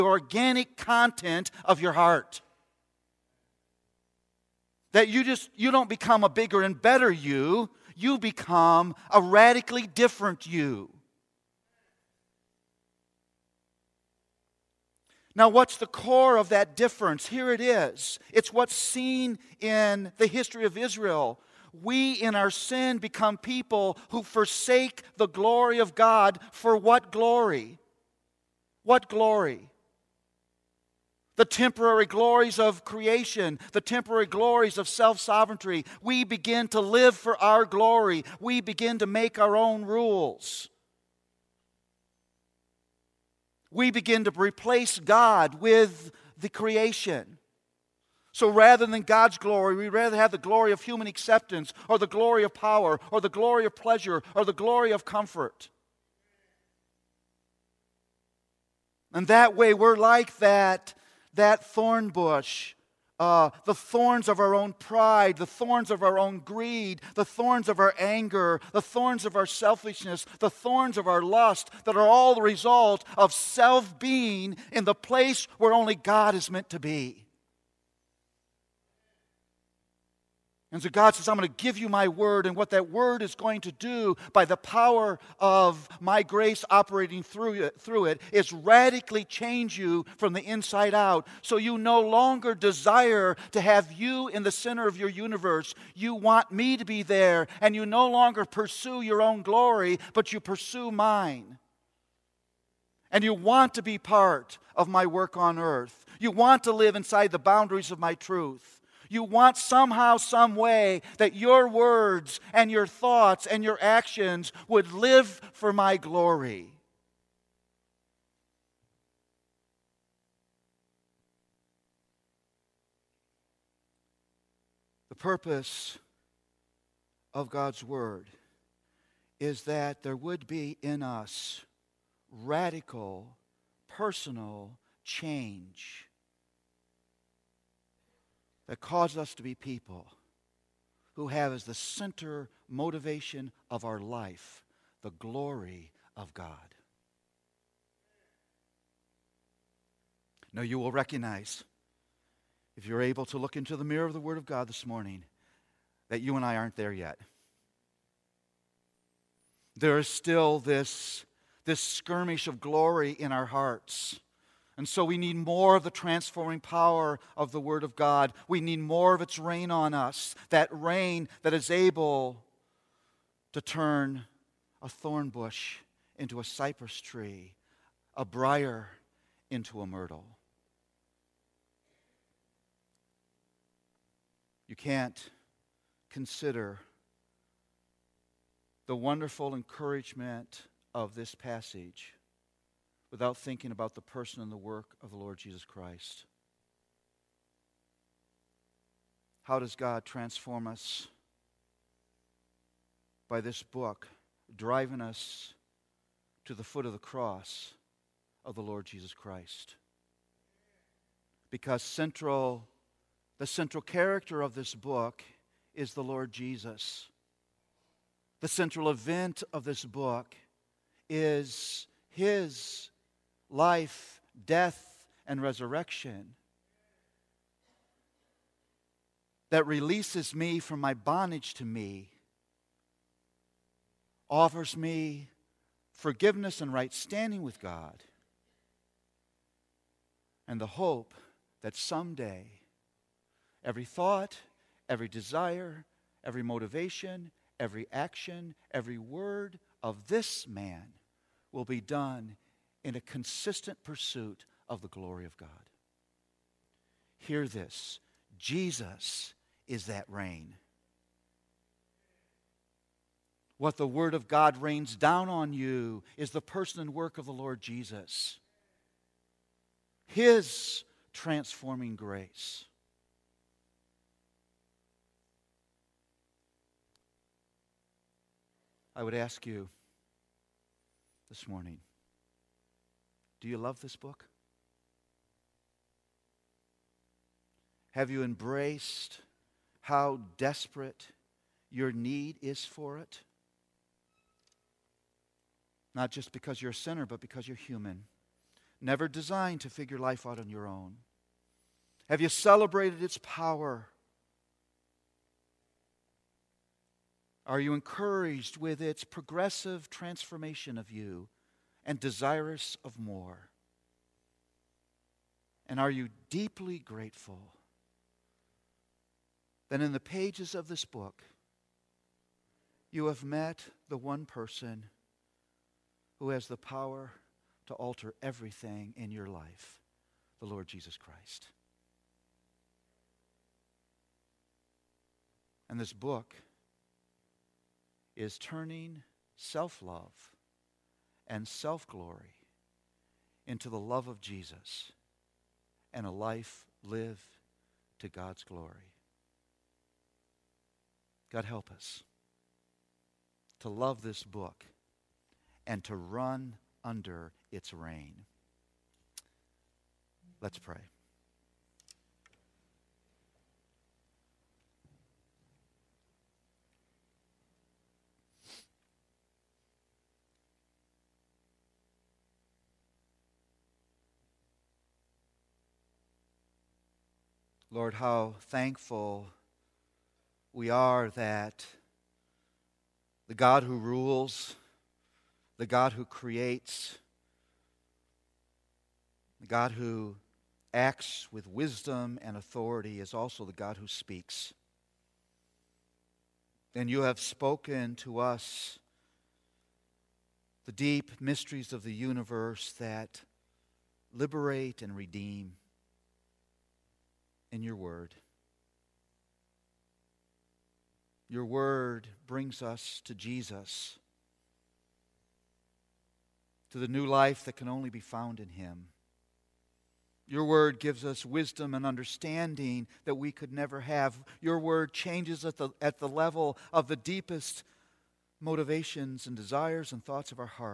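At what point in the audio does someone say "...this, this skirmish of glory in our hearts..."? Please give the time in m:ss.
2:40.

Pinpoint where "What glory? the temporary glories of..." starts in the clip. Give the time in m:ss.
0:28.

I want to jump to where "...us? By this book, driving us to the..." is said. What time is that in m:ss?
3:20.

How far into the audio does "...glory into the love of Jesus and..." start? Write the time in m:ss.
5:41.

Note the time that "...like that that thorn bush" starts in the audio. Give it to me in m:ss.
0:59.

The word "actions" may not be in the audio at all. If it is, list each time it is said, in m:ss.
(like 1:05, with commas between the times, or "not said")
1:53, 4:07.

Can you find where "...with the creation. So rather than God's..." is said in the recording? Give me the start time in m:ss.
0:45.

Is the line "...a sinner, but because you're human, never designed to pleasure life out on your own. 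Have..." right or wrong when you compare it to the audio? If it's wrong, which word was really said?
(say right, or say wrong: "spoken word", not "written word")
wrong: "figure", not "pleasure".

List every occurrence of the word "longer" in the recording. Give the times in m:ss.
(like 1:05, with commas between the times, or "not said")
1:32, 1:38.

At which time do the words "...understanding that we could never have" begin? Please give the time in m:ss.
7:01.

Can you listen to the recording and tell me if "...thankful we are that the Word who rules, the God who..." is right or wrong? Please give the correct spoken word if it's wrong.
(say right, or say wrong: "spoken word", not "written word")
wrong: "God", not "Word".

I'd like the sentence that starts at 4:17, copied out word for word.
Hear this Jesus is that rain.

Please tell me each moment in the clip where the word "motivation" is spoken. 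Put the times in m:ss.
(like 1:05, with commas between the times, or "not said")
2:22, 4:06, 7:08.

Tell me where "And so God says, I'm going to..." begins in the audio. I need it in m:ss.
1:20.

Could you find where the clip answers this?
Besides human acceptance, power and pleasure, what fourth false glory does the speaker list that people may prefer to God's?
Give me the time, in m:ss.
0:55.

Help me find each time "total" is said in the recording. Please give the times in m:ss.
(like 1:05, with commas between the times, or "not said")
not said.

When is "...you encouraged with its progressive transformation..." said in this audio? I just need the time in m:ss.
5:07.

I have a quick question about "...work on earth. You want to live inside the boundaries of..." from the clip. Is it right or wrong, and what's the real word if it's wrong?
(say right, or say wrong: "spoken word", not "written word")
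right.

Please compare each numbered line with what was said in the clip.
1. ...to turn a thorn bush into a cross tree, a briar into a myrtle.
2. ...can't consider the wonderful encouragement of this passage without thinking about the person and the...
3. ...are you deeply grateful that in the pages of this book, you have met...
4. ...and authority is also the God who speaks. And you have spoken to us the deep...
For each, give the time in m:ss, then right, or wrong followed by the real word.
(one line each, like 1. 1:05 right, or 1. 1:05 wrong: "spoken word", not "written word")
1. 2:53 wrong: "cypress", not "cross"
2. 3:04 right
3. 5:15 right
4. 6:32 right.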